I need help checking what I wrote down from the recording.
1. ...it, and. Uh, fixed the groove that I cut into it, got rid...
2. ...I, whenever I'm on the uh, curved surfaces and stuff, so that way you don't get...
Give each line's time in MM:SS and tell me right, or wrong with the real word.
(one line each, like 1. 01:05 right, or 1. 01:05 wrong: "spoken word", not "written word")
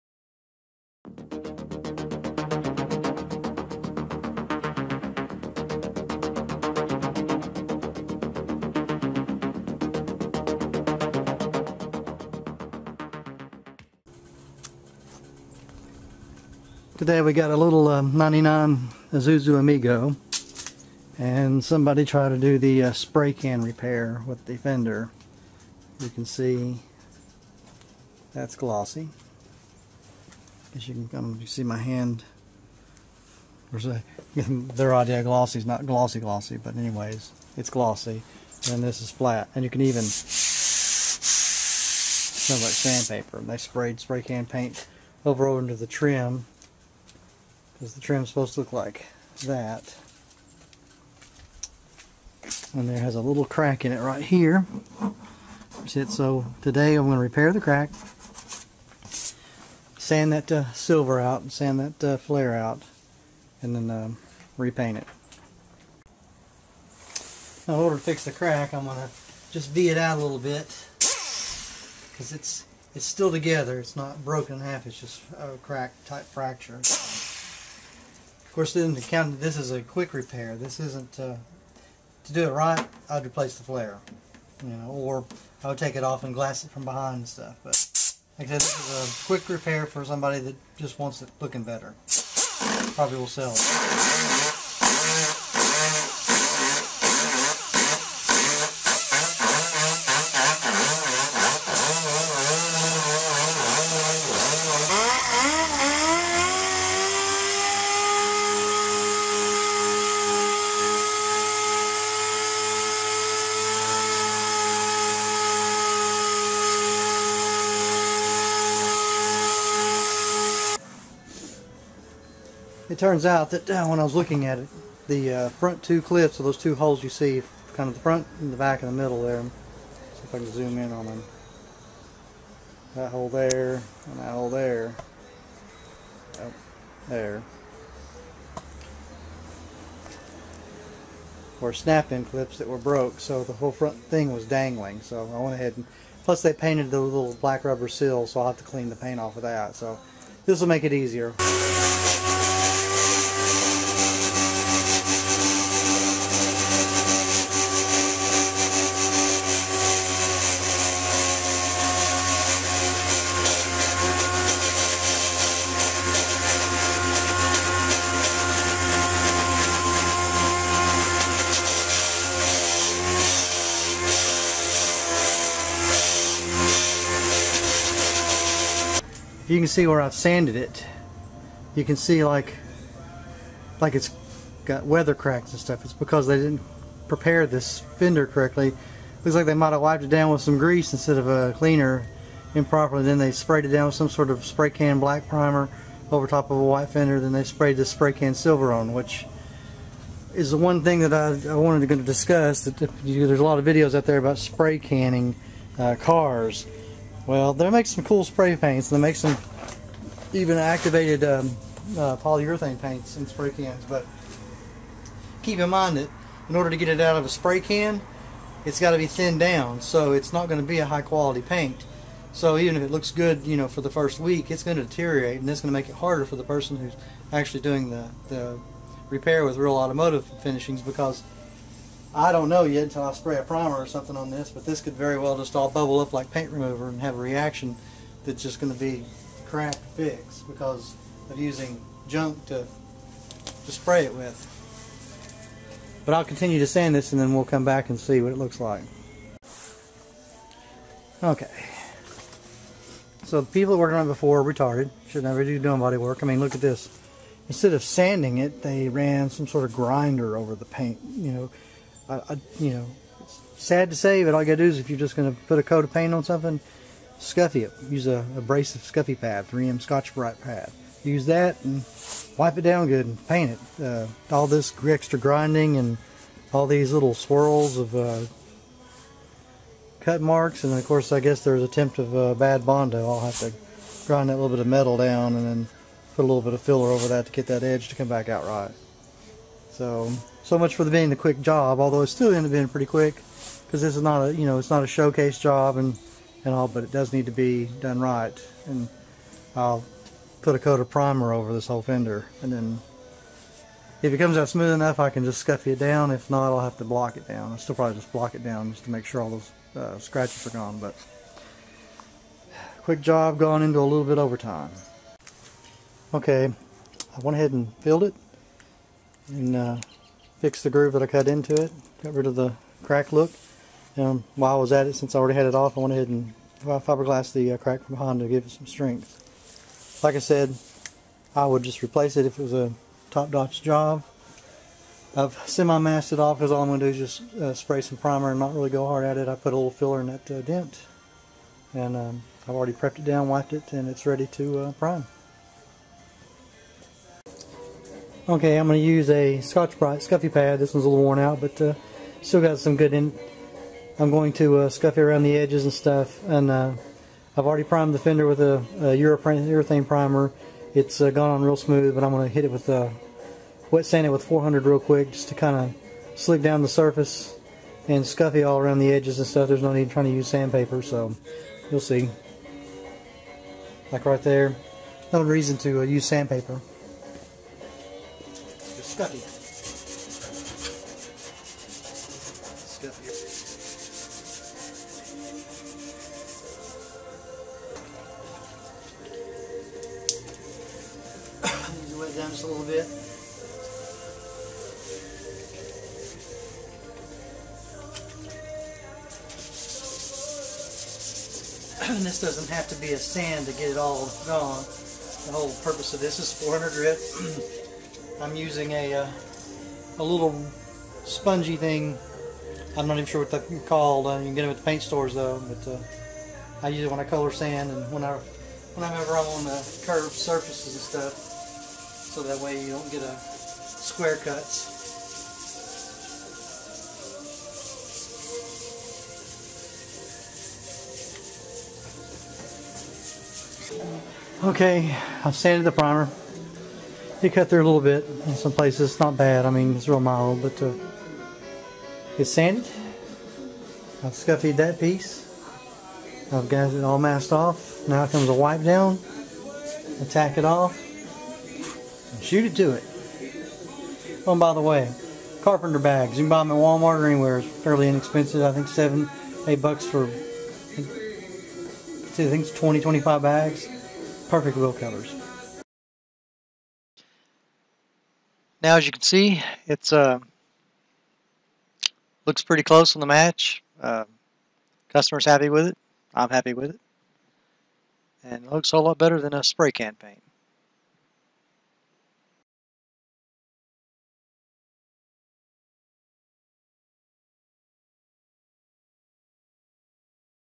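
1. 05:18 right
2. 06:58 right.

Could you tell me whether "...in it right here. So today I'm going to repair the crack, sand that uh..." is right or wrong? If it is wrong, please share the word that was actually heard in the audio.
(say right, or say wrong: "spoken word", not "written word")
right.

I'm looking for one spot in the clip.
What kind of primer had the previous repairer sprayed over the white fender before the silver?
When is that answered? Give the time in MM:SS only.
03:15.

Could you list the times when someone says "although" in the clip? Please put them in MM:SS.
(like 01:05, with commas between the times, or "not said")
04:51.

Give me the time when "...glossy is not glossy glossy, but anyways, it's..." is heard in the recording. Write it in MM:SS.
00:35.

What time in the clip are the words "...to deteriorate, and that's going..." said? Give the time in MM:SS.
03:44.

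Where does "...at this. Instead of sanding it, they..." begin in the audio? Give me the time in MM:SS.
04:16.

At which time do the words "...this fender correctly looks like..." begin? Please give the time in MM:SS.
03:07.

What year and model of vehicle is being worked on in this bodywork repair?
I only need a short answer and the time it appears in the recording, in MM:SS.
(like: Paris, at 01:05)
99 Isuzu Amigo, at 00:18.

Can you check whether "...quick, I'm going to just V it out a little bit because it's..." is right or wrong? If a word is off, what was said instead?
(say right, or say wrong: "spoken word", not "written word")
wrong: "crack", not "quick".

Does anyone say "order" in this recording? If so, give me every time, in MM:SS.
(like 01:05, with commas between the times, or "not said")
01:07, 03:36.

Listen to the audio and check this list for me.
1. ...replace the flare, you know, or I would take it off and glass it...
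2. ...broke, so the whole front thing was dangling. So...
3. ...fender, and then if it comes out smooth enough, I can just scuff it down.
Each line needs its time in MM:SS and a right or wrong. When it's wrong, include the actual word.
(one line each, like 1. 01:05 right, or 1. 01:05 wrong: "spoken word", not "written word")
1. 01:23 right
2. 02:22 right
3. 05:01 right.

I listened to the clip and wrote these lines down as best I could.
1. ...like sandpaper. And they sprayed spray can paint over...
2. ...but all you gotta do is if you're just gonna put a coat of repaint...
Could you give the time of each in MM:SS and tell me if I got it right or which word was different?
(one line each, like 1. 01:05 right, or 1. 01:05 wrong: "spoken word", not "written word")
1. 00:42 right
2. 04:24 wrong: "paint", not "repaint".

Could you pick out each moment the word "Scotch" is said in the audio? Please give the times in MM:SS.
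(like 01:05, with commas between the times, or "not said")
04:29, 05:49.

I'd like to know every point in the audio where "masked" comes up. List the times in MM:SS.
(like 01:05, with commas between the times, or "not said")
05:35, 07:26.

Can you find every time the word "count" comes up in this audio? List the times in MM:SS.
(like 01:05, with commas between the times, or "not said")
01:19.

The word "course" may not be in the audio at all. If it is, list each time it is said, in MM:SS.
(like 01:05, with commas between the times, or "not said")
01:18, 04:40.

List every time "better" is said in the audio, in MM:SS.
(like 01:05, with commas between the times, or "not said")
01:31, 07:58.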